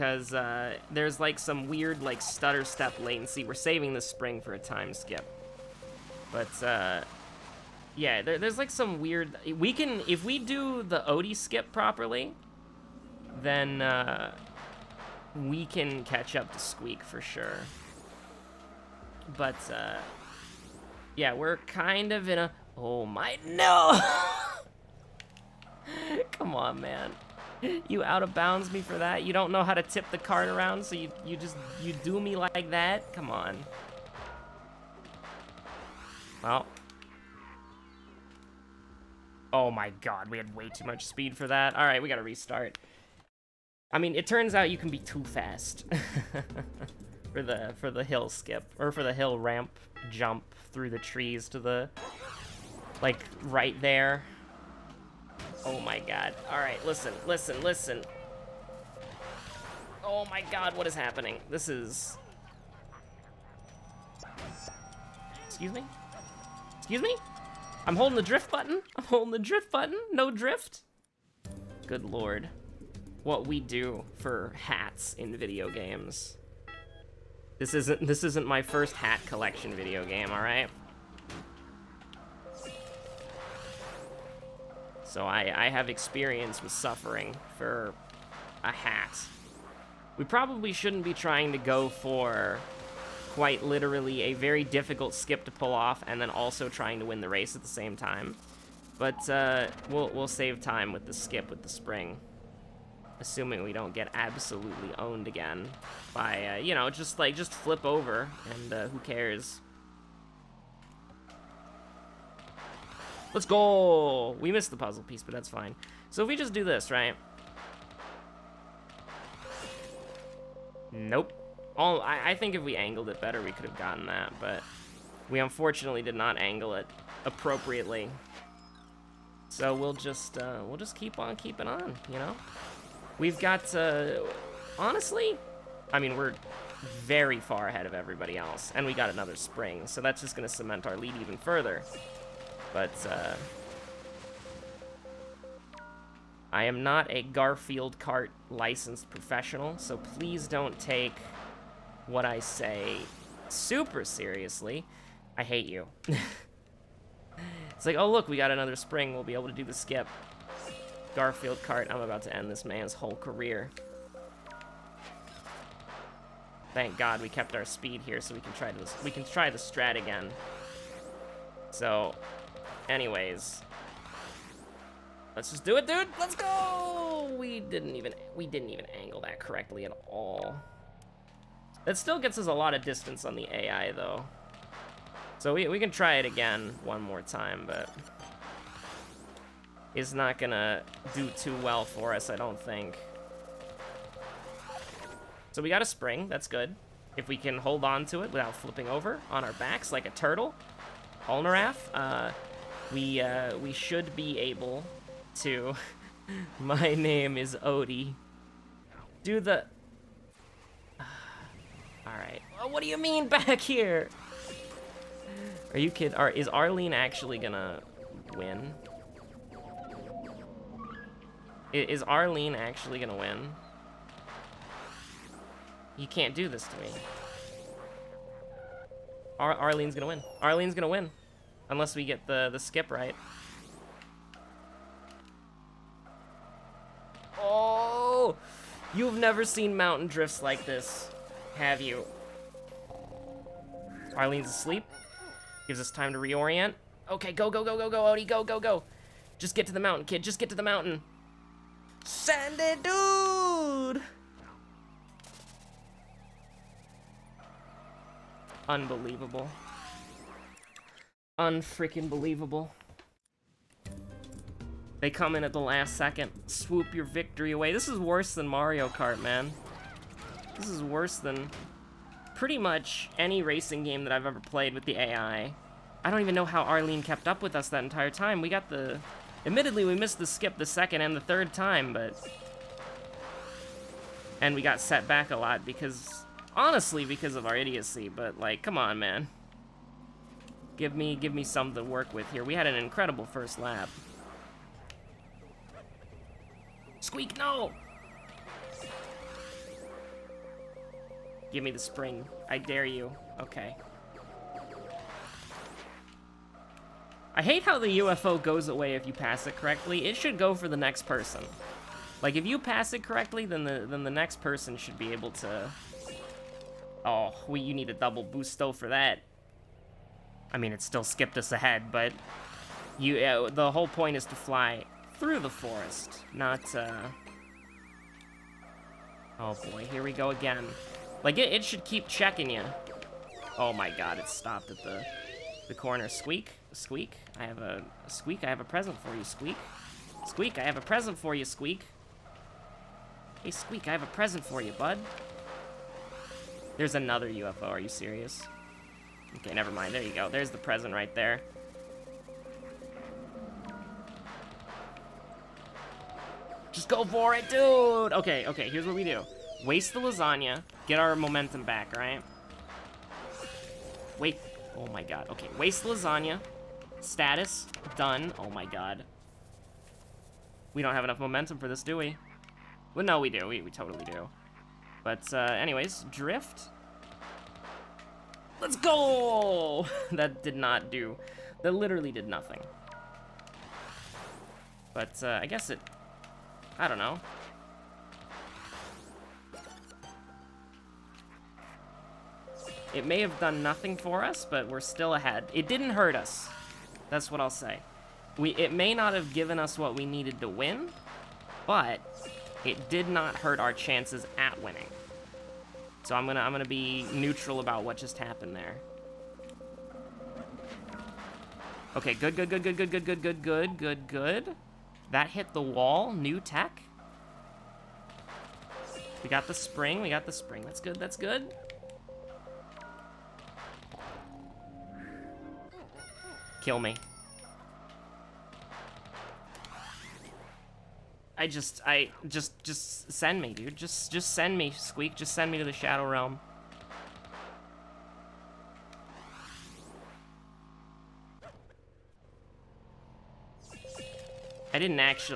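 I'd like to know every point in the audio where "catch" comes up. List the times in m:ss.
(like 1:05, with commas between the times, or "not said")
0:16.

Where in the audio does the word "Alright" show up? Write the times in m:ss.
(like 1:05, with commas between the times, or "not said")
0:41, 3:32.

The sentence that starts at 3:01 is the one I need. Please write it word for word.
That still gets us a lot of distance on the AI though.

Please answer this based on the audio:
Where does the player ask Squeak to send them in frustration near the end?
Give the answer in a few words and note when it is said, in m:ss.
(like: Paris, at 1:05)
the Shadow Realm, at 7:15.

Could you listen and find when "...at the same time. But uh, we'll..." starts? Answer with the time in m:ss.
1:37.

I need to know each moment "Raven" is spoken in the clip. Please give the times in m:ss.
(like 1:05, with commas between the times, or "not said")
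not said.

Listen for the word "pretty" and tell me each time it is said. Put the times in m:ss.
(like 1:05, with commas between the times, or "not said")
4:32.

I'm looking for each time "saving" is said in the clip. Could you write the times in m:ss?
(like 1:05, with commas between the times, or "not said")
0:03.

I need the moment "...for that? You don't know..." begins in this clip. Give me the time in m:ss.
0:28.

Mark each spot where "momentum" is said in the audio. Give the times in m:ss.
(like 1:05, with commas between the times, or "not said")
6:01, 6:11.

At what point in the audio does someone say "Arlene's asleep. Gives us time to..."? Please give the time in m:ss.
4:04.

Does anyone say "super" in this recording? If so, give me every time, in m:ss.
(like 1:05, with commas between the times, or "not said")
2:33.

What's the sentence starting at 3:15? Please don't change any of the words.
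So we got a spring, that's good.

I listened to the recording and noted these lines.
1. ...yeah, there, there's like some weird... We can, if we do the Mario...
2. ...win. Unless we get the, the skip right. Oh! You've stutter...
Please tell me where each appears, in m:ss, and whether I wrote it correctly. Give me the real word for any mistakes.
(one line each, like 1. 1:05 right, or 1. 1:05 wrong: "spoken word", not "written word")
1. 0:07 wrong: "Odie", not "Mario"
2. 3:50 wrong: "never", not "stutter".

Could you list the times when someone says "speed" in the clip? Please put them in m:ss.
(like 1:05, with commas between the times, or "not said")
0:41, 2:47.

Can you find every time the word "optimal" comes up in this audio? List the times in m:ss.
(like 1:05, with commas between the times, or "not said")
not said.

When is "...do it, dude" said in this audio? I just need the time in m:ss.
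2:55.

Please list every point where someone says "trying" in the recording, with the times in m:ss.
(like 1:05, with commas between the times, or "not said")
1:31, 1:36.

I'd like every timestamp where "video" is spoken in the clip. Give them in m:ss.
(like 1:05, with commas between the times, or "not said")
1:15, 1:19.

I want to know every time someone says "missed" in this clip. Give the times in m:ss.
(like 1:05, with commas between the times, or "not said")
1:54, 4:39.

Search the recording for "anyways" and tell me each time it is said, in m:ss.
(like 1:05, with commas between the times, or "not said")
2:52, 6:15.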